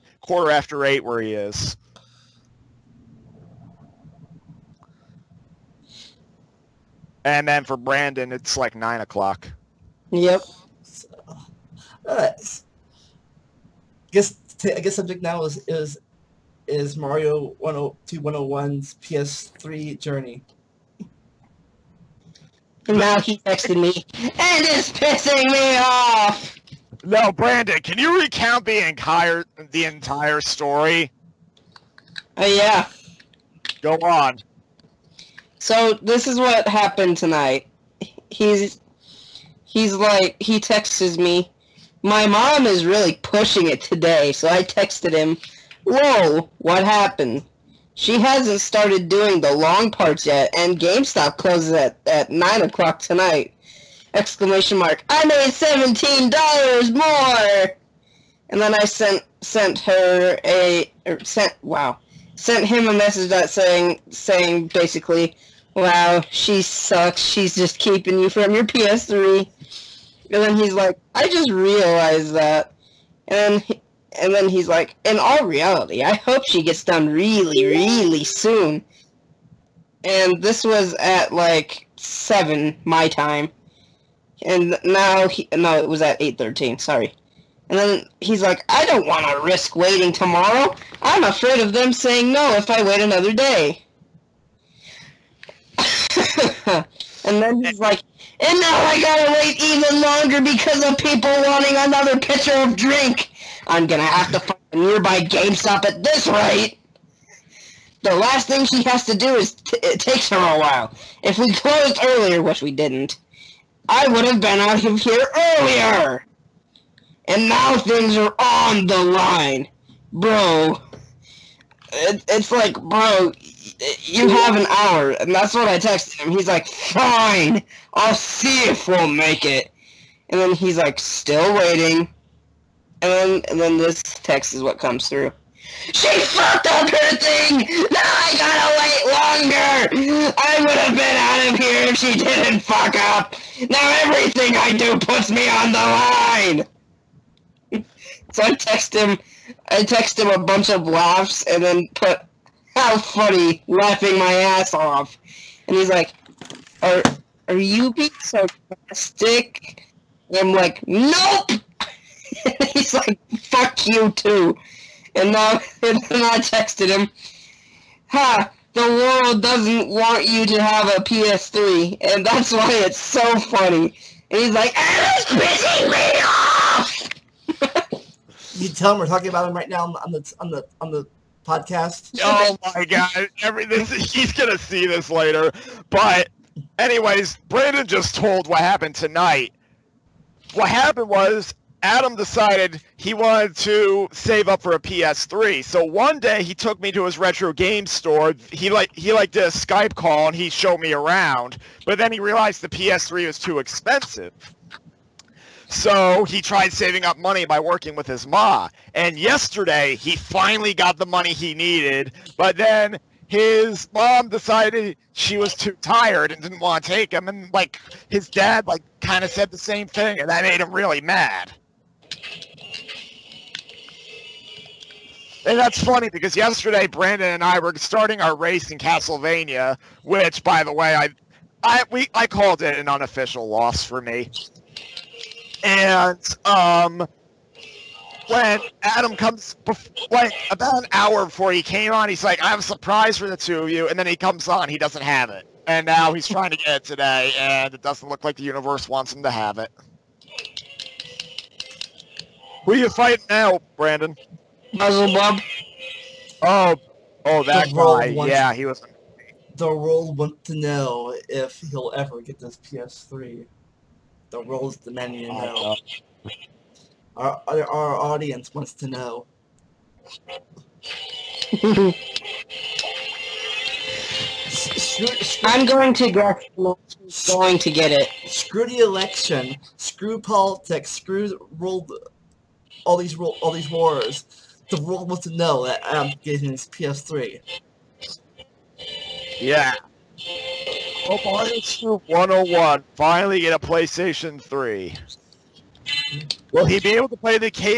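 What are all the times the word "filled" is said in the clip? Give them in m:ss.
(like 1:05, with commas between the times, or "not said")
not said.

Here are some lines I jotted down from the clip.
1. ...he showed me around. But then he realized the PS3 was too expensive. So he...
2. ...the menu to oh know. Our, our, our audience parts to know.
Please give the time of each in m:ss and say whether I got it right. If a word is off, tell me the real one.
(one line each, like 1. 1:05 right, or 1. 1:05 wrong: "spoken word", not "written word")
1. 3:20 right
2. 4:24 wrong: "wants", not "parts".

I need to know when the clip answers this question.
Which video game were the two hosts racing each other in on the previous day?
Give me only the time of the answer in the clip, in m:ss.
3:48.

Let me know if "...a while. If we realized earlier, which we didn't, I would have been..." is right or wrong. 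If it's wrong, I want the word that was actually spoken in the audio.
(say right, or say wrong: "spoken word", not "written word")
wrong: "closed", not "realized".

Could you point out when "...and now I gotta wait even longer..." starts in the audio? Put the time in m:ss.
1:38.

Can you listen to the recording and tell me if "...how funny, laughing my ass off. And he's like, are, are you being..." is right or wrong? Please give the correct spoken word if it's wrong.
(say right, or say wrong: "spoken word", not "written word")
right.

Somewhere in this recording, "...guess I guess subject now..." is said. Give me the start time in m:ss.
0:14.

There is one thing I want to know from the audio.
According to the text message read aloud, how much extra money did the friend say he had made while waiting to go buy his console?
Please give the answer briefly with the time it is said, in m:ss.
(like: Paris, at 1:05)
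$17, at 0:55.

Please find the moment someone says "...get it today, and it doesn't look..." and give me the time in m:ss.
4:06.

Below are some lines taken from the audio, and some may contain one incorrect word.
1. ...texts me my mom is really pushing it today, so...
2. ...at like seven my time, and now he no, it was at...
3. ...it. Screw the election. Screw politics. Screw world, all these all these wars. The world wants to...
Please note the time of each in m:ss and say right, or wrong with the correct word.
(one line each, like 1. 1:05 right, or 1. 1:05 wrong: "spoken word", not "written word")
1. 0:40 right
2. 1:20 right
3. 4:37 right.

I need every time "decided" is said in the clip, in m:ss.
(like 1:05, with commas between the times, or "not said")
3:12, 3:34.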